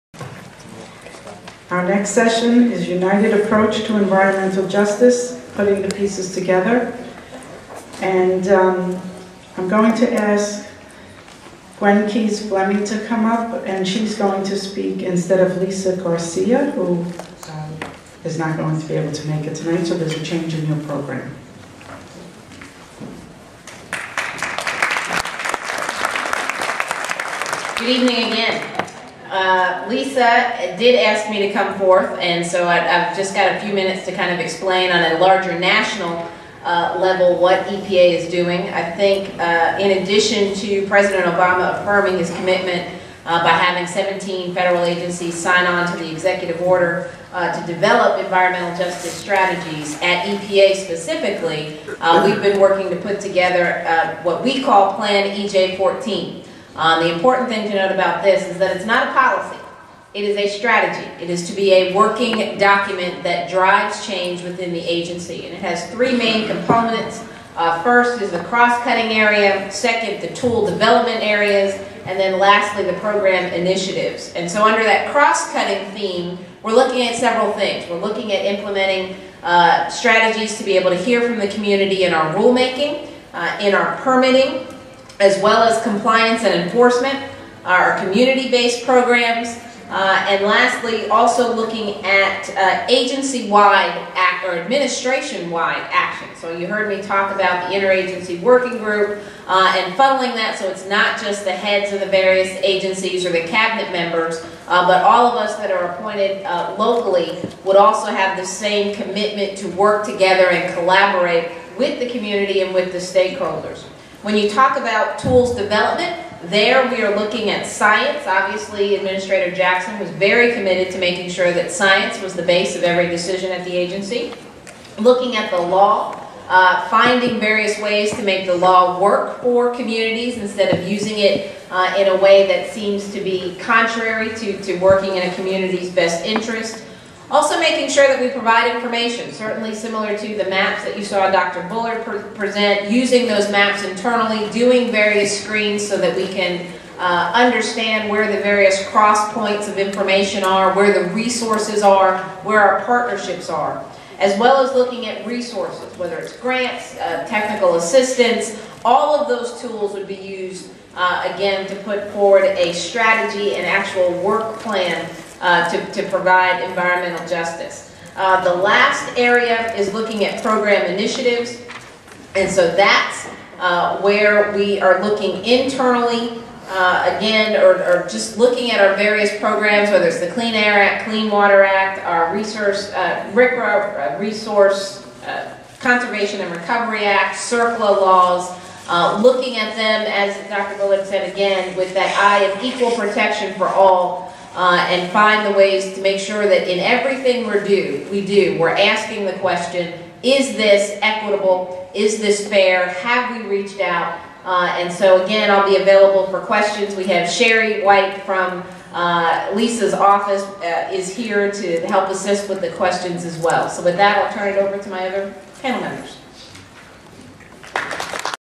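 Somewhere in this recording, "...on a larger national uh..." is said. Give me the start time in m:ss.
0:34.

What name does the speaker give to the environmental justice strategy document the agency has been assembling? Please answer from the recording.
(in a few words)
Plan EJ 14.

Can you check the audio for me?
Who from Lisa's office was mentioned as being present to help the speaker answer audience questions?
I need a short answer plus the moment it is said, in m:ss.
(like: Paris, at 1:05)
Sherry White, at 3:27.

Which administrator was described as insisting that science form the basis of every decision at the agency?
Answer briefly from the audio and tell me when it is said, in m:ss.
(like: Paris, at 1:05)
Administrator Jackson, at 1:58.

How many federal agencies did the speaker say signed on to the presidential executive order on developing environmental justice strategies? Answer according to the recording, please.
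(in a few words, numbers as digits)
17.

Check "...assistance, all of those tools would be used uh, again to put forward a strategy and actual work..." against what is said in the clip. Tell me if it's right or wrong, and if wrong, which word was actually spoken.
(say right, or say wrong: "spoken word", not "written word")
right.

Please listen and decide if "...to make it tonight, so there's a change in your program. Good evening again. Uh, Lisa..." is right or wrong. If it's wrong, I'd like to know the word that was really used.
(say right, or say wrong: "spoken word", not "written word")
right.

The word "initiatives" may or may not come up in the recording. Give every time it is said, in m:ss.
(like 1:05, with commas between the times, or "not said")
1:13, 2:50.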